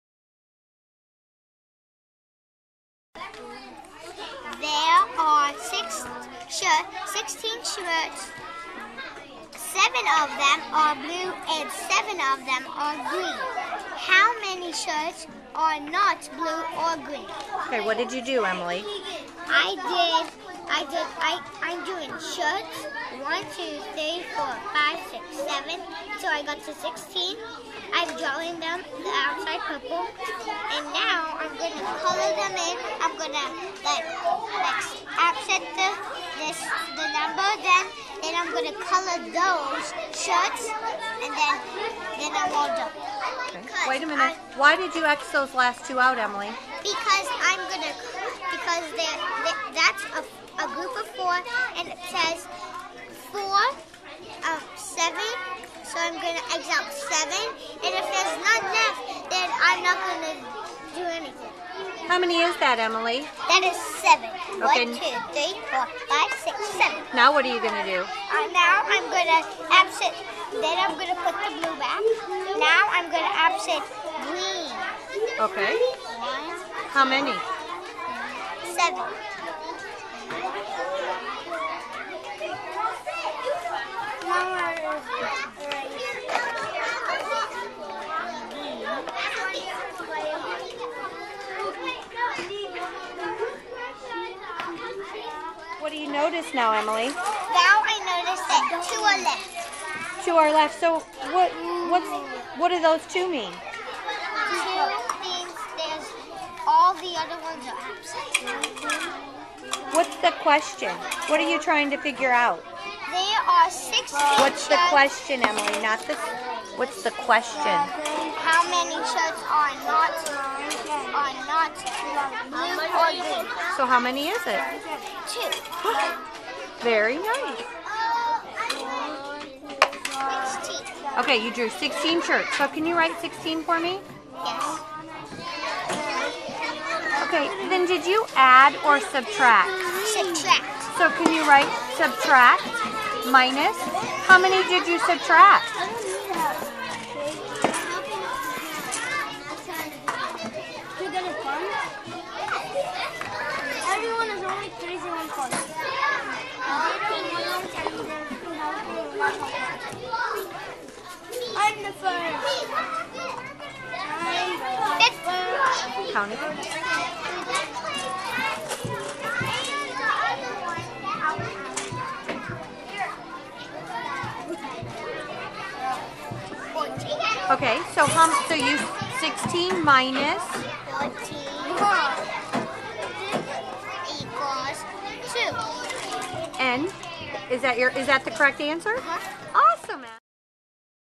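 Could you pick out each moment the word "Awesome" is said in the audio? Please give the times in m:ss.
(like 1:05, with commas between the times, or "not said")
3:09.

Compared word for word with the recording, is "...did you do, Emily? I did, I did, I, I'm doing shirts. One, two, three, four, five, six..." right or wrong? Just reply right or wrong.
right.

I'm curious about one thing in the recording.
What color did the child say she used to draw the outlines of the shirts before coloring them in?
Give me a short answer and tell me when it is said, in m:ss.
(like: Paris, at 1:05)
Purple, at 0:29.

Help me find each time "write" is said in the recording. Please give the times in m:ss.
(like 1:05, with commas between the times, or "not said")
2:12, 2:21.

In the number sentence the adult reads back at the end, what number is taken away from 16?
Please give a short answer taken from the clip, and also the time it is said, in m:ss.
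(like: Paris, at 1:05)
14, at 3:00.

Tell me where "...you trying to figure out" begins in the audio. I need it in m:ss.
1:51.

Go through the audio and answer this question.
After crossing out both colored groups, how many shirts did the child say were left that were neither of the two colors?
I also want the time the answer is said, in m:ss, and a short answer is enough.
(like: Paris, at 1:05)
2, at 2:05.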